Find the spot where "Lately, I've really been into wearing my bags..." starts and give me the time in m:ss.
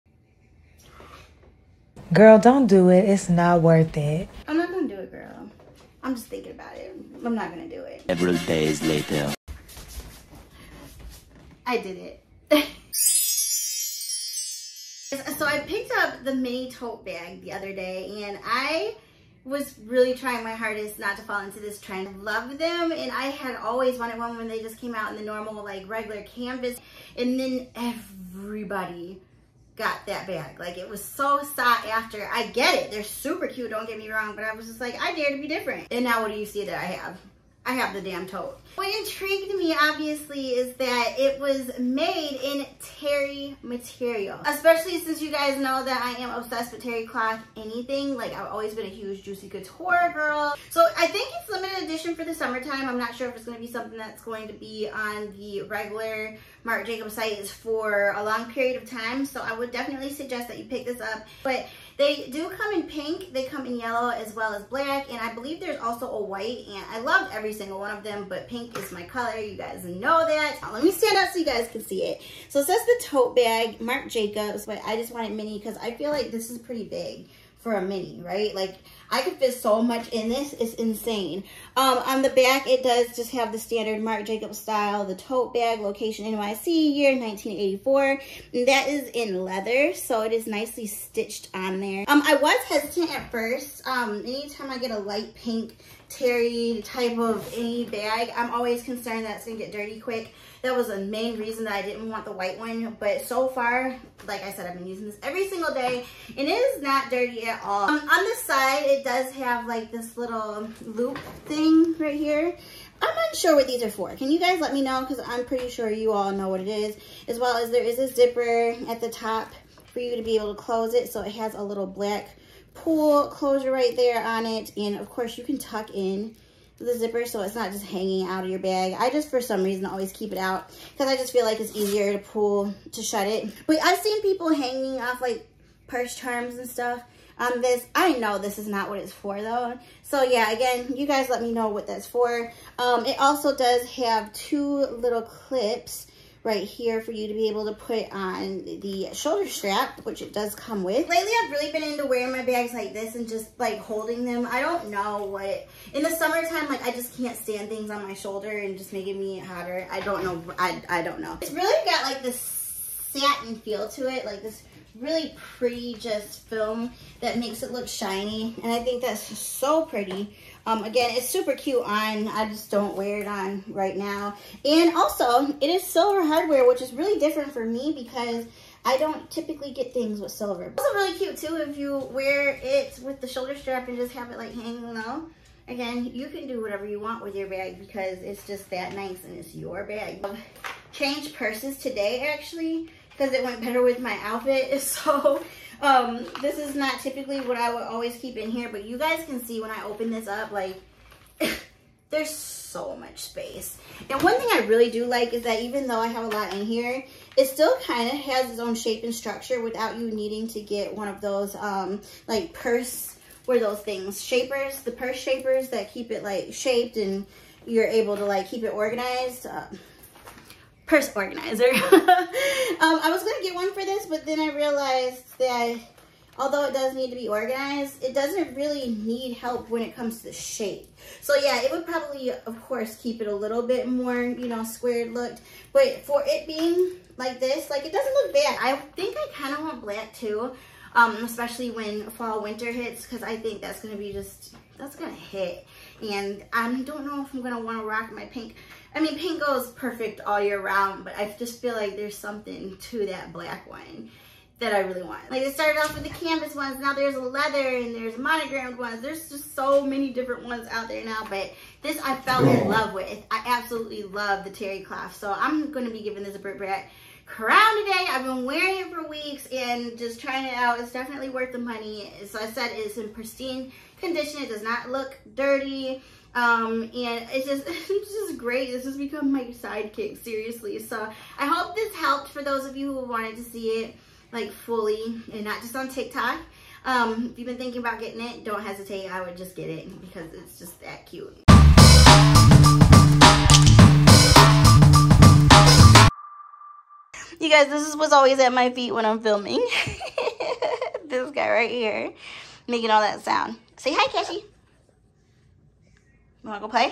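2:31.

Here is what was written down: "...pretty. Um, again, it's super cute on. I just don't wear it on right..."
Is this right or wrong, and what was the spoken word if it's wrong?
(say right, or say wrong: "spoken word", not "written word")
right.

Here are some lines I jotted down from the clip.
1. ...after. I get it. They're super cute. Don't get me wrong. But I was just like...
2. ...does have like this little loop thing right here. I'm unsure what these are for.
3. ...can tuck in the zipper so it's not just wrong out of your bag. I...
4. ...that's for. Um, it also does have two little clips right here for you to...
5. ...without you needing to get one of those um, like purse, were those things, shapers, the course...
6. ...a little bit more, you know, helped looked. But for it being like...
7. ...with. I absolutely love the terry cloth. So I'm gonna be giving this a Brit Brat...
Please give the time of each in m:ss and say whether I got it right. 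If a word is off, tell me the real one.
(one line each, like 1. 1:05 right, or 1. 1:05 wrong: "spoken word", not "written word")
1. 0:31 right
2. 1:49 right
3. 2:05 wrong: "hanging", not "wrong"
4. 2:21 right
5. 3:29 wrong: "purse", not "course"
6. 3:53 wrong: "squared", not "helped"
7. 4:22 right.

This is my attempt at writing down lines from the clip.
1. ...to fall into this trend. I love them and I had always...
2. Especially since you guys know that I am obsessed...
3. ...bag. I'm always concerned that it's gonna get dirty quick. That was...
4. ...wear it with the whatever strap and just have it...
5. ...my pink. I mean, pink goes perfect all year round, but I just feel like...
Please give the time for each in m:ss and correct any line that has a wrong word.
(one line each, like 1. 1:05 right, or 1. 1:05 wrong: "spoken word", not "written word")
1. 0:21 right
2. 0:44 right
3. 1:37 right
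4. 3:02 wrong: "shoulder", not "whatever"
5. 4:08 right.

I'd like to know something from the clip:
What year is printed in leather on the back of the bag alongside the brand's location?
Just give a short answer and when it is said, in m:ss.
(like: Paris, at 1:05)
1984, at 1:27.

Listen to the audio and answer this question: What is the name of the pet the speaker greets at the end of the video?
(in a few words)
Cassie.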